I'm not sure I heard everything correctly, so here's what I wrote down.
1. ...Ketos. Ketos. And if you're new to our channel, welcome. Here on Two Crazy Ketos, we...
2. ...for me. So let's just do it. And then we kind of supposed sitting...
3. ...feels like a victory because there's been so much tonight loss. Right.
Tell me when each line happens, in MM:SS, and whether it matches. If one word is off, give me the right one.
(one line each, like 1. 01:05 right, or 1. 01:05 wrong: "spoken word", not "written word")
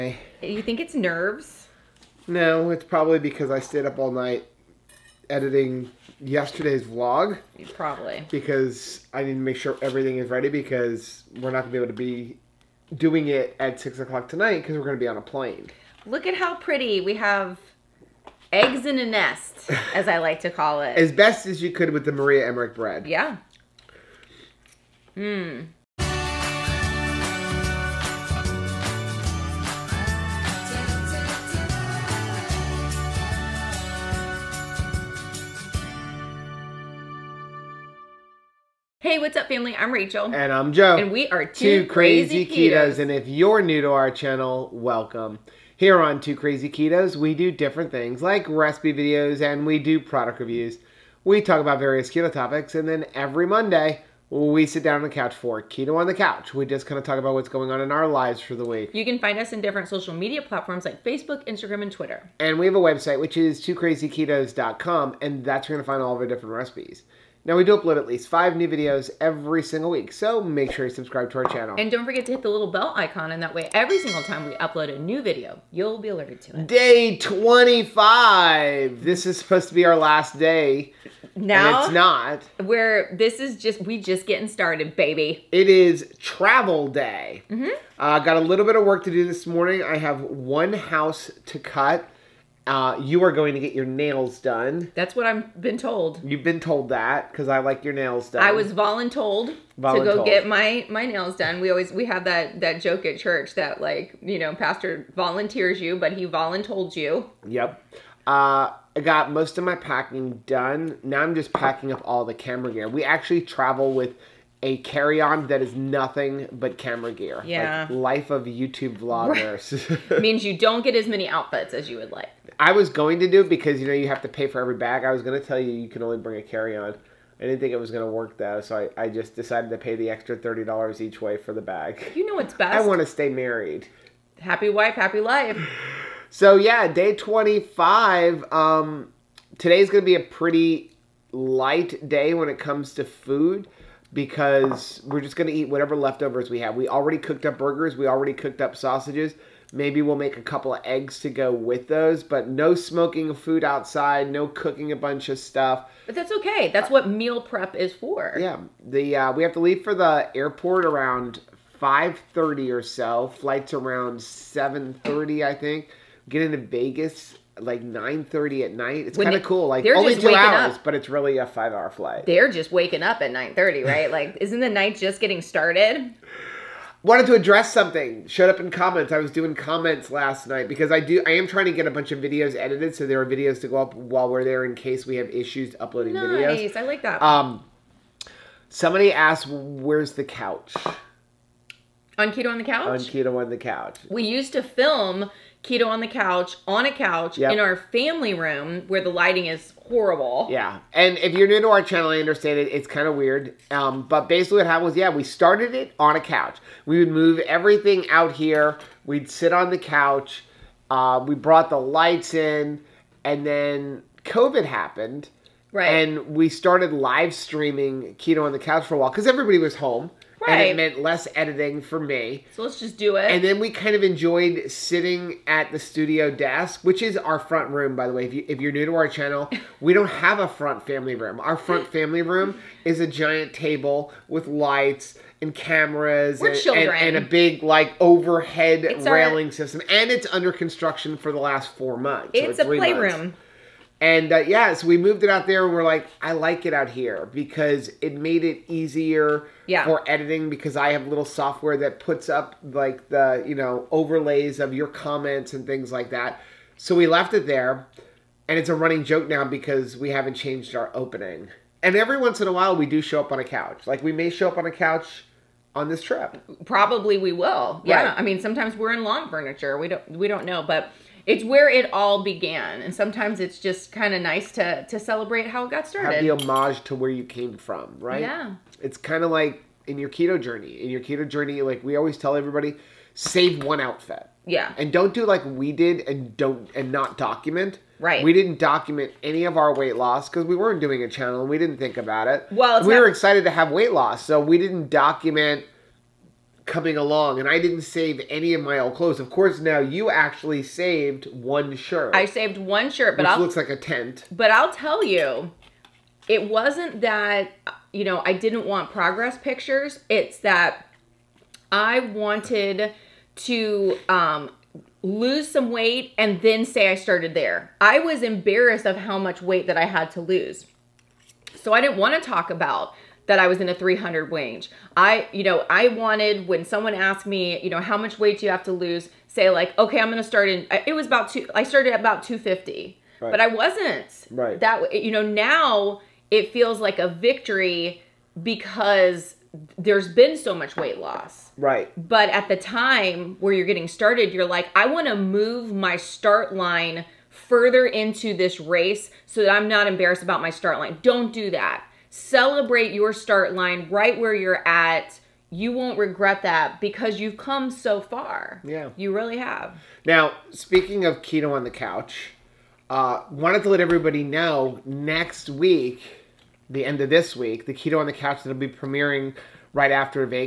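1. 00:42 right
2. 03:41 wrong: "enjoyed", not "supposed"
3. 05:36 wrong: "weight", not "tonight".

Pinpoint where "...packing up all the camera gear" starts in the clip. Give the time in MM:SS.
01:51.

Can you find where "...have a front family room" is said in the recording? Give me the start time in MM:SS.
03:50.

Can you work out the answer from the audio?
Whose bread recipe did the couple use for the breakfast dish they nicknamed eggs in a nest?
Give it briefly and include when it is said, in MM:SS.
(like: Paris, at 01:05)
Maria Emmerich, at 00:22.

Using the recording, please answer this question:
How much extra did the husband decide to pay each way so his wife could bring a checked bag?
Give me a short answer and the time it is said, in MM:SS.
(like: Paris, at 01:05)
$30, at 02:10.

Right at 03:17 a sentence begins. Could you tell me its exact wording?
in our family room where the lighting is horrible.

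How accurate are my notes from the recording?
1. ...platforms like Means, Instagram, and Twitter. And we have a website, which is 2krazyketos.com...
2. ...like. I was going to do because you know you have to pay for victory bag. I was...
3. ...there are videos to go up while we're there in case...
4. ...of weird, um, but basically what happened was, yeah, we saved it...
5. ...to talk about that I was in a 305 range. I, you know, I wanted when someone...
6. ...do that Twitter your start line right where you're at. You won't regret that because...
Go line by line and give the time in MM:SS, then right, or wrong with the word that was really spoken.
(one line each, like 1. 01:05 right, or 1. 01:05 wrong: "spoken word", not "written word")
1. 01:00 wrong: "Facebook", not "Means"
2. 02:02 wrong: "every", not "victory"
3. 03:03 right
4. 03:23 wrong: "started", not "saved"
5. 05:22 wrong: "300", not "305"
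6. 05:51 wrong: "Celebrate", not "Twitter".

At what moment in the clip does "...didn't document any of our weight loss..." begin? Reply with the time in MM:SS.
04:48.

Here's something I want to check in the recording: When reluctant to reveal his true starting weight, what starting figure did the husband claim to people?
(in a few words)
250.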